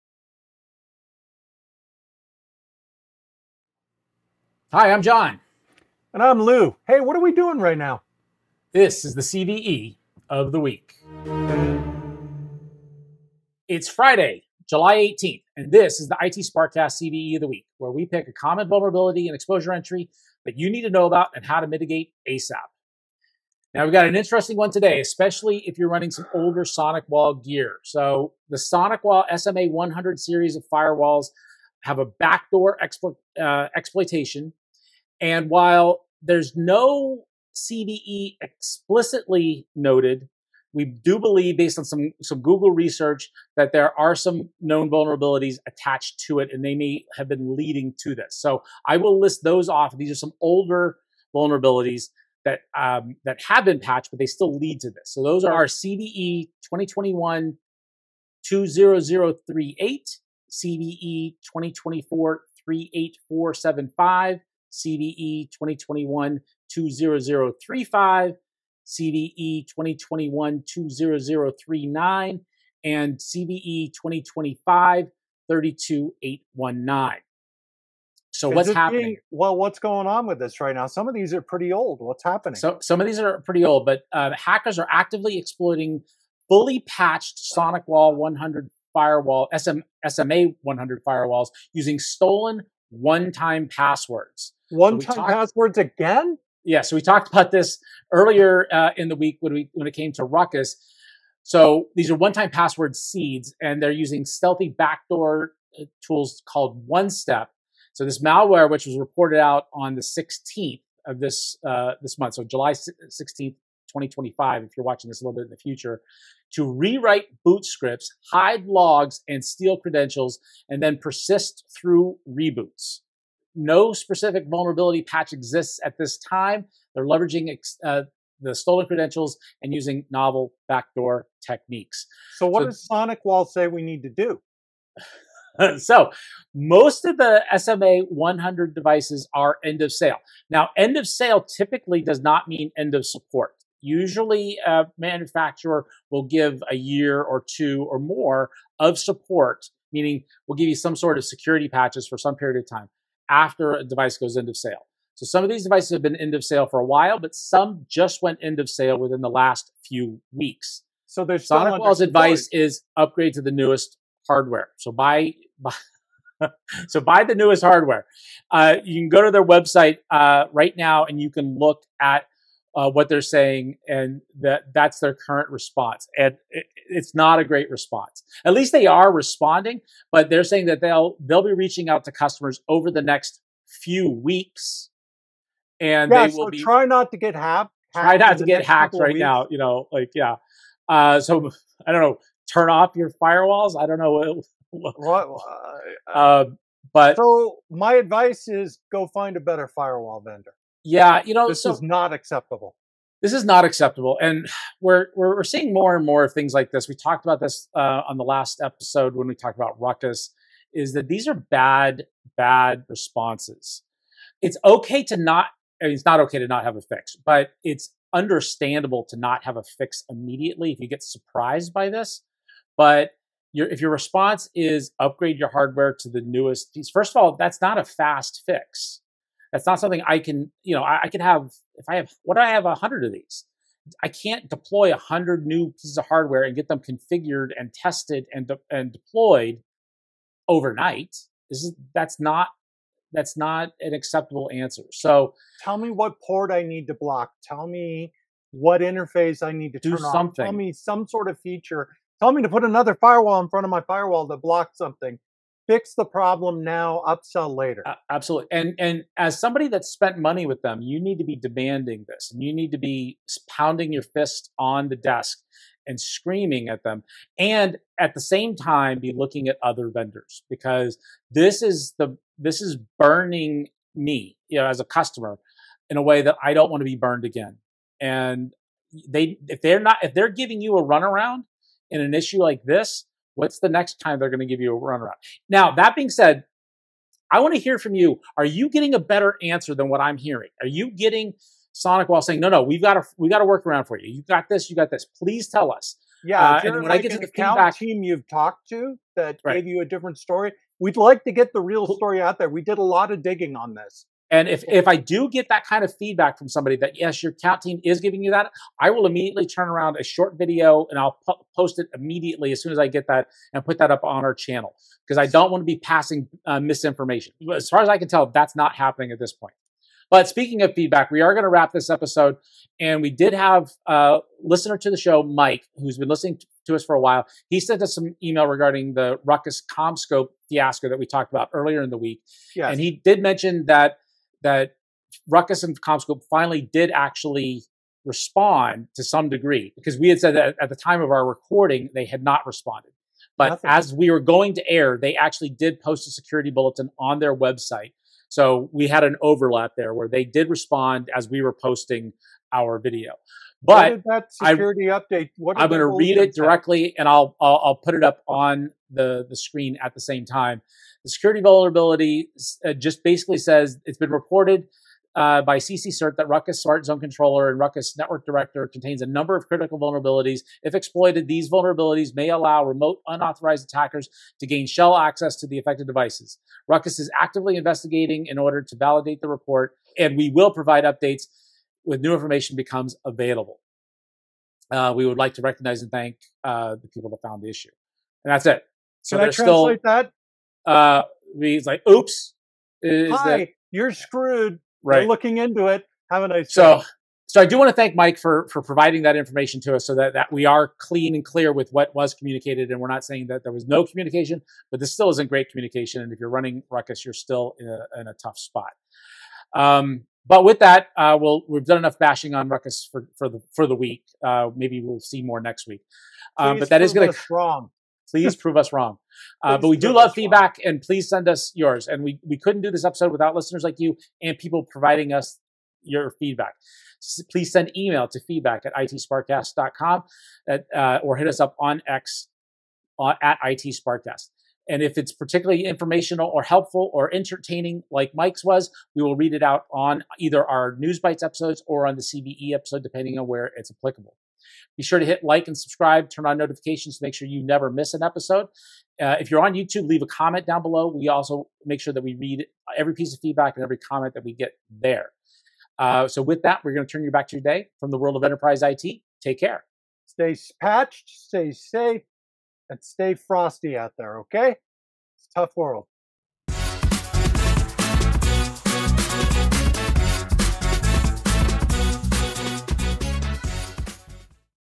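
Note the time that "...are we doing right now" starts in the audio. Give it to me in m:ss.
0:07.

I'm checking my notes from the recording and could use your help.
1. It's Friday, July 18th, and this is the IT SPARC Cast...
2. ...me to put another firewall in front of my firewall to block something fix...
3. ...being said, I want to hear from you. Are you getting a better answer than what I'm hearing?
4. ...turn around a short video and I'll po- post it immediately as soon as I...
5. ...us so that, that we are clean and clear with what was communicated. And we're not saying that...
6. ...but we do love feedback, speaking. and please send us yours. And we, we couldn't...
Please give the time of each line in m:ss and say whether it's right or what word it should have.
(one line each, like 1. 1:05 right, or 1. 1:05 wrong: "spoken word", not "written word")
1. 0:13 right
2. 4:12 right
3. 4:45 right
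4. 5:09 right
5. 6:39 right
6. 6:59 wrong: "wrong", not "speaking".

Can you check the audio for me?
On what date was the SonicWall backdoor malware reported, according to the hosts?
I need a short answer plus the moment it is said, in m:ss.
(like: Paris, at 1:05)
July 16th, 2025, at 1:52.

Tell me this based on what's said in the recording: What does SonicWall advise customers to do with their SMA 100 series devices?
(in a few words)
Upgrade to the newest hardware.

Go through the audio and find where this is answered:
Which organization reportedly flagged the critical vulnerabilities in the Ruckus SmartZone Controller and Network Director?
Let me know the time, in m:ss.
6:05.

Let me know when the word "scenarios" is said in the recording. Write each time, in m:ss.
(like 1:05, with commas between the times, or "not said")
not said.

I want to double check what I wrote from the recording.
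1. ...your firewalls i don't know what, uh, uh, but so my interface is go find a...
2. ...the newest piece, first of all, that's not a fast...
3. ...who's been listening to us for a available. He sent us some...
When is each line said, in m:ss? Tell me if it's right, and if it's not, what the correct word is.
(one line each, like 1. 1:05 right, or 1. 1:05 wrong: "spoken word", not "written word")
1. 3:12 wrong: "advice", not "interface"
2. 3:46 right
3. 5:25 wrong: "while", not "available".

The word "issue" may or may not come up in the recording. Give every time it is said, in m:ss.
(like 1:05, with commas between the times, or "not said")
4:42, 6:27.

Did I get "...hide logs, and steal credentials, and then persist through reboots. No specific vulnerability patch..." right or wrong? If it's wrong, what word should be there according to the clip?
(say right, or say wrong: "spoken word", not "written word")
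right.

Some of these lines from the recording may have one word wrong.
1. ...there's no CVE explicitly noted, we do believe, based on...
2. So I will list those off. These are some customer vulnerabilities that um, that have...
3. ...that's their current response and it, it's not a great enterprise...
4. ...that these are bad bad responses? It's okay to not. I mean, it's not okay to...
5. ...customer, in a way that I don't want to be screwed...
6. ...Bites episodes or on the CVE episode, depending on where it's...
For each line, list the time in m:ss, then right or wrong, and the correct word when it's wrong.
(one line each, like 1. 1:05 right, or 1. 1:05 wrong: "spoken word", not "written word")
1. 0:36 right
2. 0:48 wrong: "older", not "customer"
3. 2:54 wrong: "response", not "enterprise"
4. 3:30 right
5. 4:34 wrong: "burned", not "screwed"
6. 7:20 right.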